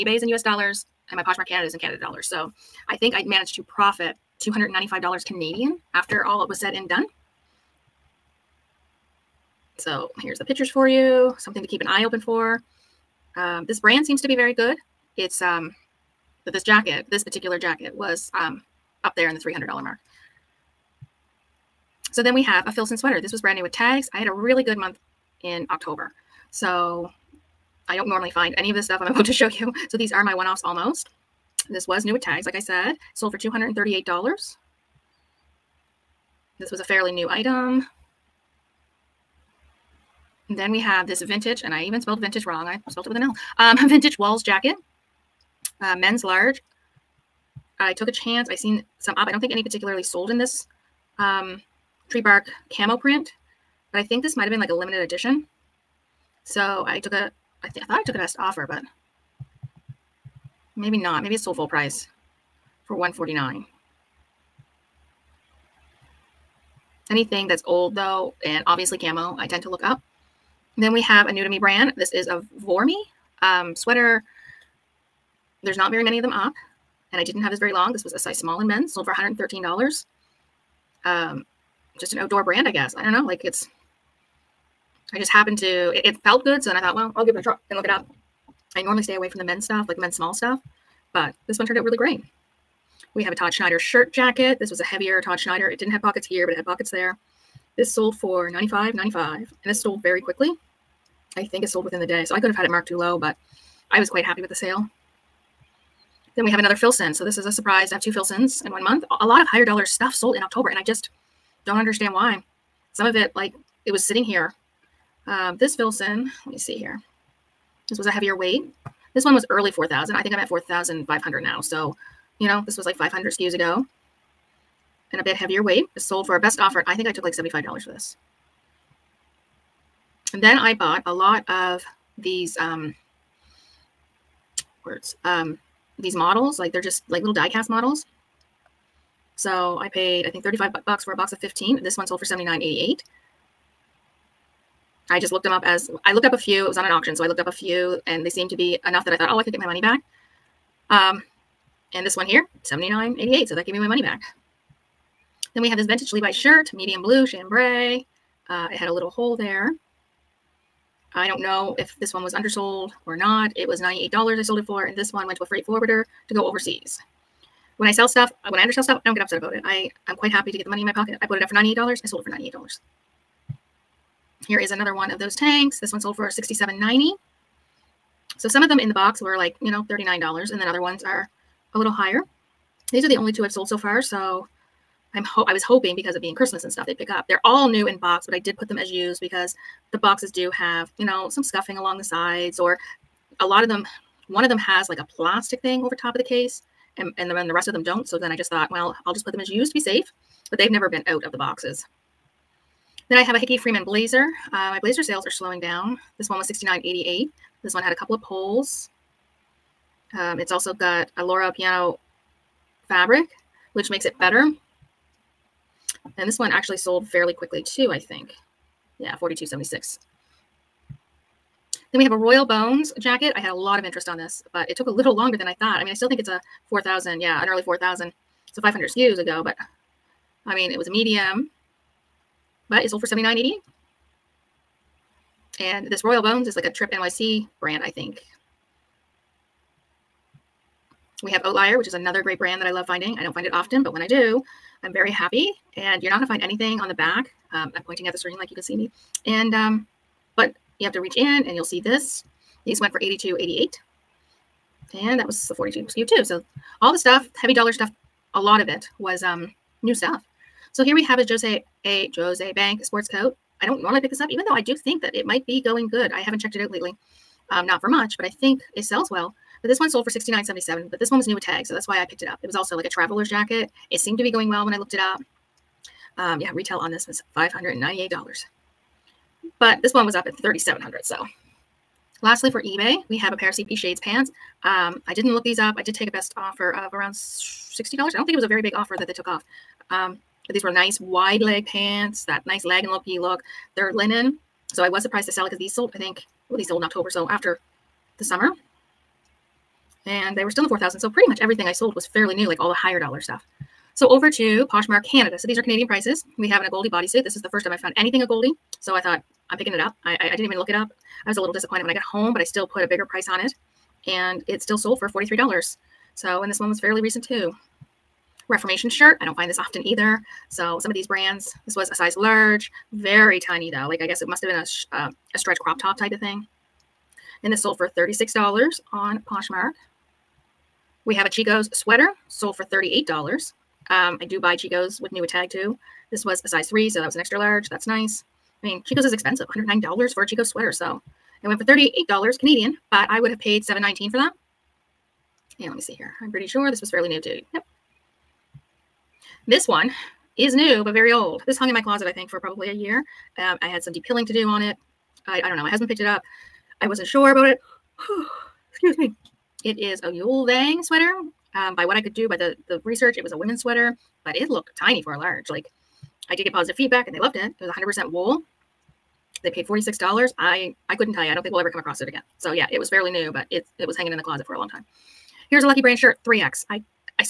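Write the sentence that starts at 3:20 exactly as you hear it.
But they've never been out of the boxes.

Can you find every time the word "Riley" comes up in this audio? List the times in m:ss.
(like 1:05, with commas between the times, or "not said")
not said.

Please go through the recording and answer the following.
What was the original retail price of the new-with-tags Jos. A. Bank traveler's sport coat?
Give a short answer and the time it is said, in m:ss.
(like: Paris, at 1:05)
$598, at 4:37.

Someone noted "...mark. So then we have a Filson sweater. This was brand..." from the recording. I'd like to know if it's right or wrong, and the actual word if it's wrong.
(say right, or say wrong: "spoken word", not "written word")
right.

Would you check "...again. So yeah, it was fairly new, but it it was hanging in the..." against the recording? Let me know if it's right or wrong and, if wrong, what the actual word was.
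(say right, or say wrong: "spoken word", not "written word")
right.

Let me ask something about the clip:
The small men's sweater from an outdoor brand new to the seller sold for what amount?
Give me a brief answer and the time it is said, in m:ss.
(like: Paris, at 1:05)
$113, at 1:18.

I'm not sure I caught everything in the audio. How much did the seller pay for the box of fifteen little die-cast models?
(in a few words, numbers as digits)
35 bucks.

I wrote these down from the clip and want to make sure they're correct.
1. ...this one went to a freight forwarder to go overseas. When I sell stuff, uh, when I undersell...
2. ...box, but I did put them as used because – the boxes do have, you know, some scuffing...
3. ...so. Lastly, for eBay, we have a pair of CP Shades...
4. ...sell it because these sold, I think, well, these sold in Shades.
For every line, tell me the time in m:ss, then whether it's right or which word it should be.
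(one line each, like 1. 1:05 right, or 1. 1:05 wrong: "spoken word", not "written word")
1. 2:44 right
2. 3:07 right
3. 4:41 right
4. 4:55 wrong: "October", not "Shades".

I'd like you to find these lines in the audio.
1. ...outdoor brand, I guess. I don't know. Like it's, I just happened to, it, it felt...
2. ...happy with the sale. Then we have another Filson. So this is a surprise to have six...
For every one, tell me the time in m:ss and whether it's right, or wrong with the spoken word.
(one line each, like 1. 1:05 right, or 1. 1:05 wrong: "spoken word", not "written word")
1. 1:22 right
2. 1:44 wrong: "two", not "six".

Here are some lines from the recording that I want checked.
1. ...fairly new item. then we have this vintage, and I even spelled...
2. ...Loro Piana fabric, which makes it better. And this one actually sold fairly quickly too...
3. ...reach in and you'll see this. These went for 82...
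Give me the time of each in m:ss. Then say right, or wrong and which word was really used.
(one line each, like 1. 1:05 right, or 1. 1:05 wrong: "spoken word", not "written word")
1. 0:36 right
2. 3:31 right
3. 4:10 right.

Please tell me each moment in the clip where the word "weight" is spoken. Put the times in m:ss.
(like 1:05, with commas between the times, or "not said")
1:58, 2:05.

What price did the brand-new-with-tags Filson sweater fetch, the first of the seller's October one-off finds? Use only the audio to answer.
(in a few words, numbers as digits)
$238.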